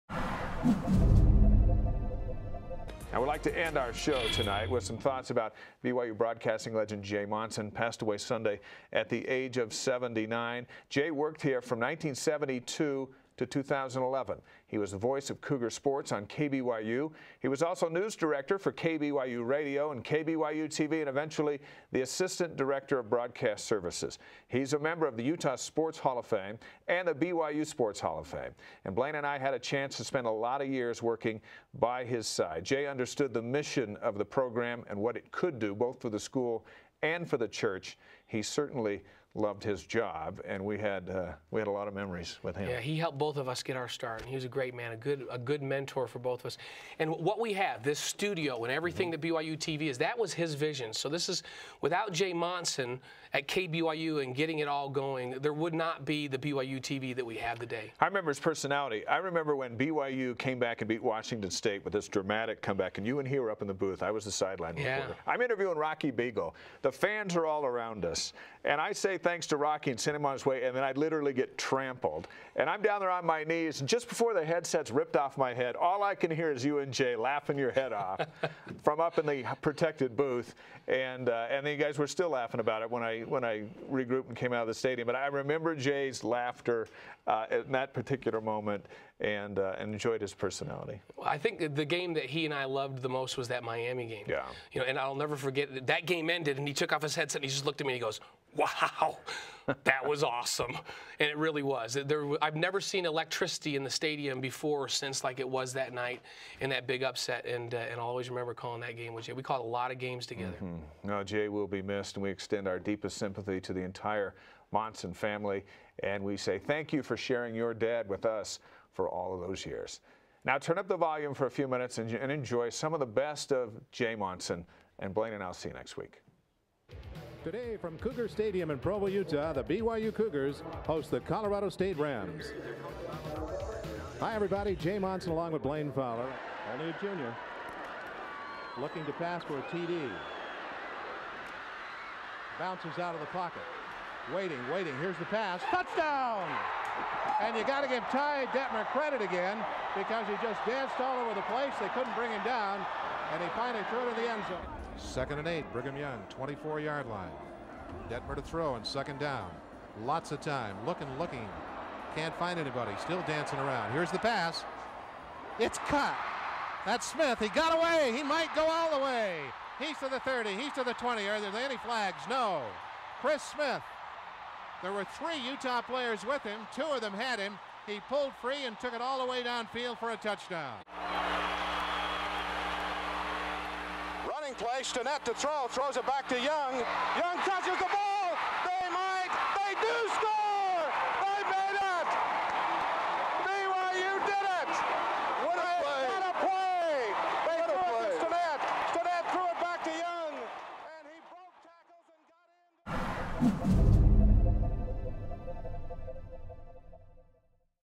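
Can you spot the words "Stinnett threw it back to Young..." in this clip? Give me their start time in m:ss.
3:18.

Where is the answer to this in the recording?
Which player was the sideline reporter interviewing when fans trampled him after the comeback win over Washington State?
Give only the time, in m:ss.
1:05.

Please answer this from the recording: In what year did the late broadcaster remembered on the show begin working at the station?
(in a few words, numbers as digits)
1972.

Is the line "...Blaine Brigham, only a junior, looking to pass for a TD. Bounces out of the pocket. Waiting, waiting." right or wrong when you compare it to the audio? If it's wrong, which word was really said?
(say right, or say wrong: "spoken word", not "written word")
wrong: "Fowler", not "Brigham".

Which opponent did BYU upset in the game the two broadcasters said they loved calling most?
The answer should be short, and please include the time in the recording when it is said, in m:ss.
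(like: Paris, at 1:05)
Miami, at 1:33.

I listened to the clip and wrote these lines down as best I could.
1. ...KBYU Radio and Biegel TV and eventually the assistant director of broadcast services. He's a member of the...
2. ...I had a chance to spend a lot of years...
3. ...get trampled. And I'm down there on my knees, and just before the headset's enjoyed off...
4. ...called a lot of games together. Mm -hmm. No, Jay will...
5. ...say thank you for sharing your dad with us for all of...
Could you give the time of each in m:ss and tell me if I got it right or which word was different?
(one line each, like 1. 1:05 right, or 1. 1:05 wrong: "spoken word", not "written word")
1. 0:18 wrong: "KBYU", not "Biegel"
2. 0:29 right
3. 1:11 wrong: "ripped", not "enjoyed"
4. 1:49 right
5. 1:56 right.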